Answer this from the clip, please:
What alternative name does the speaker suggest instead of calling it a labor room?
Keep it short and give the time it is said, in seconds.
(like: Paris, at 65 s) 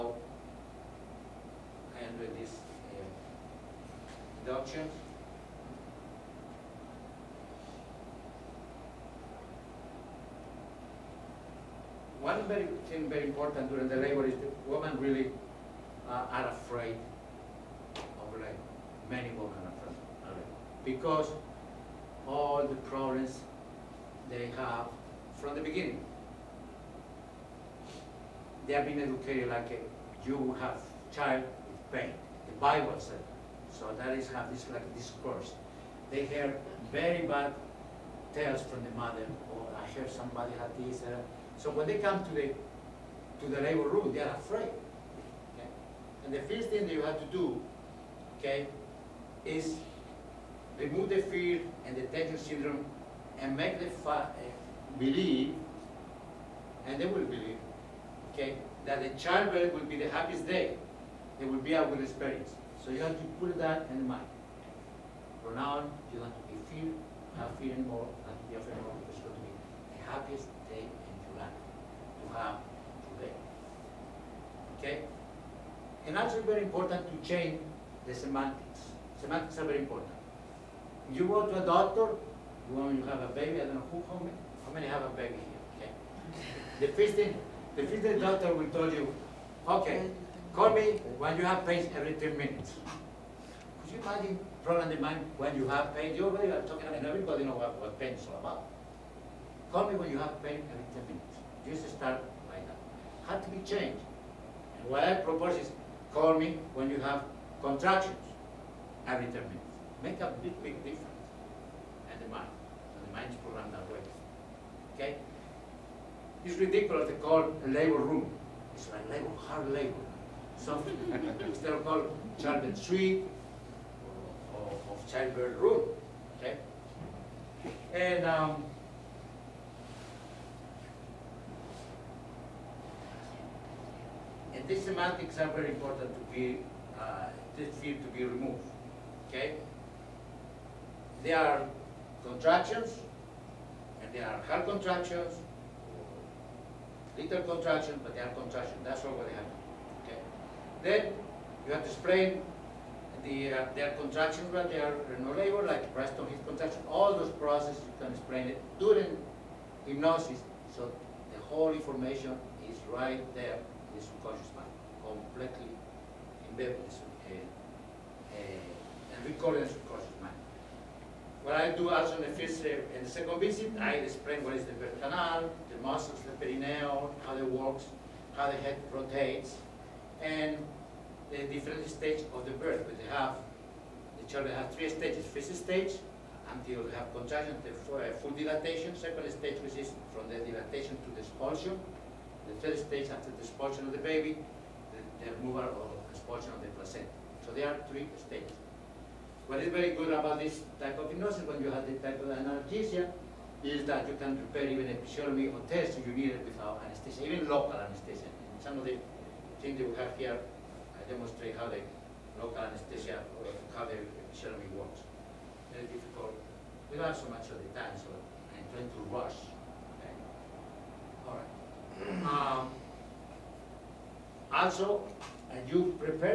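childbirth suite, at 122 s.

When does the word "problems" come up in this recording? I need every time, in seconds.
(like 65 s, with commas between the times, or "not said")
22 s, 94 s.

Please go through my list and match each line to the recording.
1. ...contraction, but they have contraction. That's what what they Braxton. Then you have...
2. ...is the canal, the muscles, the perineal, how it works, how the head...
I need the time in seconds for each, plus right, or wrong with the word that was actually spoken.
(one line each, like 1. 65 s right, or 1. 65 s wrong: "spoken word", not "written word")
1. 147 s wrong: "Okay", not "Braxton"
2. 174 s right.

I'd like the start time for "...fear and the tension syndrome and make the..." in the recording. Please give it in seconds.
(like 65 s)
51 s.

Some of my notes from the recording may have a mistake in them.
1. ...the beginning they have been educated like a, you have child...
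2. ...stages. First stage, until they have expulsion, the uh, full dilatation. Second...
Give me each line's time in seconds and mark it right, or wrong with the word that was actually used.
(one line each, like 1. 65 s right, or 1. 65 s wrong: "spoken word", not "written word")
1. 25 s right
2. 184 s wrong: "contraction", not "expulsion".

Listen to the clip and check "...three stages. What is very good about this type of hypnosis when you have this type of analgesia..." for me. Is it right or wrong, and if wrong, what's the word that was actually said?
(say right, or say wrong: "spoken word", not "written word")
right.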